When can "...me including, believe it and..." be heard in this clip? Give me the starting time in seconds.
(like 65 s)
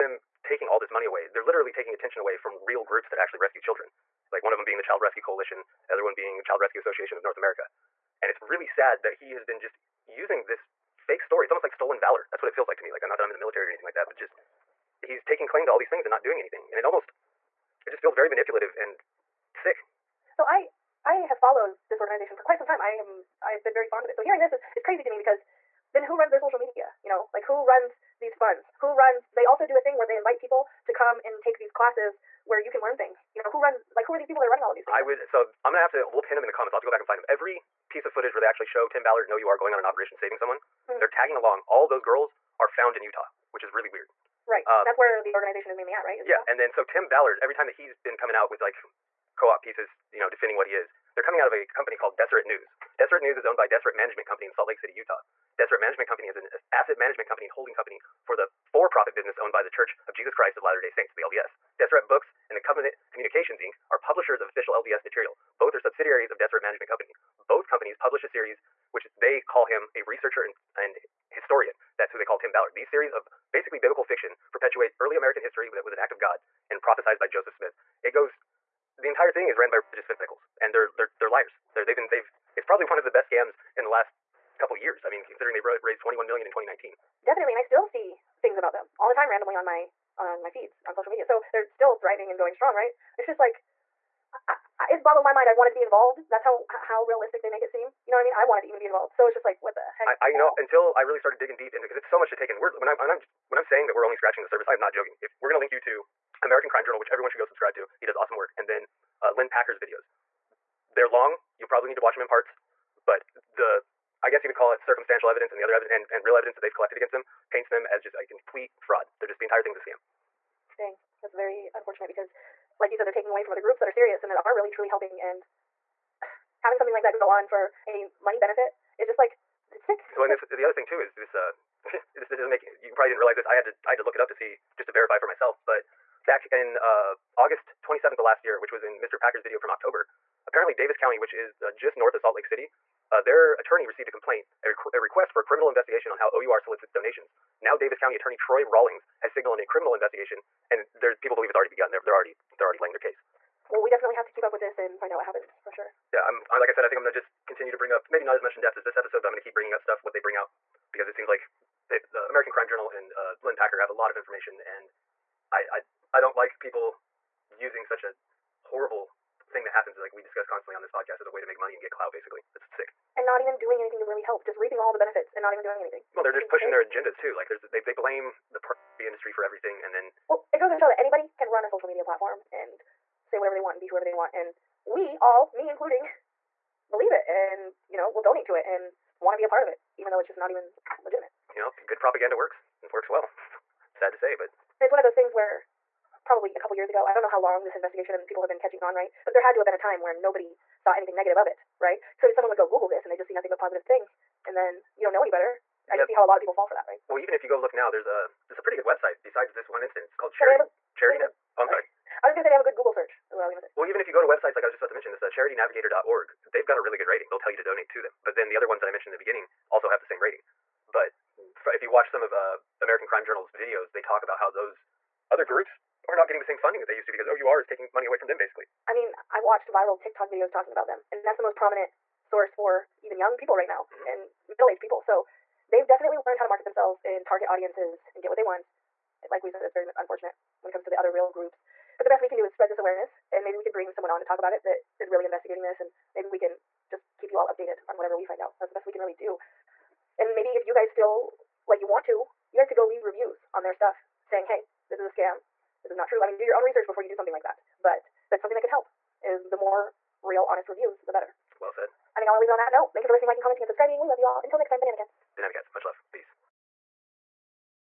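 185 s.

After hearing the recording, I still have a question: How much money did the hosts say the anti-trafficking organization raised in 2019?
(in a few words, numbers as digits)
21 million.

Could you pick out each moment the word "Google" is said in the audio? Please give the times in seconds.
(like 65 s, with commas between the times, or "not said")
202 s, 212 s.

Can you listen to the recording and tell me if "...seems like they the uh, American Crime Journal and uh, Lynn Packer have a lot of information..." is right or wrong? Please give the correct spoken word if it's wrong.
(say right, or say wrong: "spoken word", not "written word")
right.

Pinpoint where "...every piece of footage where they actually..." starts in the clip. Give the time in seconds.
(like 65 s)
37 s.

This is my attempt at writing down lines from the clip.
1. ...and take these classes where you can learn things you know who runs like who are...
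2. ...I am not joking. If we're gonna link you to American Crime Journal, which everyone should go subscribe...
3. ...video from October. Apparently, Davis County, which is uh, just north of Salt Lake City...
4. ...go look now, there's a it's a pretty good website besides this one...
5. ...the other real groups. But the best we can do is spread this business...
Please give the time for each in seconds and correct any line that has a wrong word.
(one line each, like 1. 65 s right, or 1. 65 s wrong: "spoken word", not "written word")
1. 31 s right
2. 104 s right
3. 139 s right
4. 207 s right
5. 240 s wrong: "awareness", not "business".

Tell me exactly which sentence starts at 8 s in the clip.
And it's really sad that he has been just using this fake story.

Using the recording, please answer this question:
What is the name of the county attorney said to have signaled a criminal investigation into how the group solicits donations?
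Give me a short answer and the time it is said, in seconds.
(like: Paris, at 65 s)
Troy Rawlings, at 148 s.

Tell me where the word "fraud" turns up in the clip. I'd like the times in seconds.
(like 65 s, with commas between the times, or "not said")
118 s.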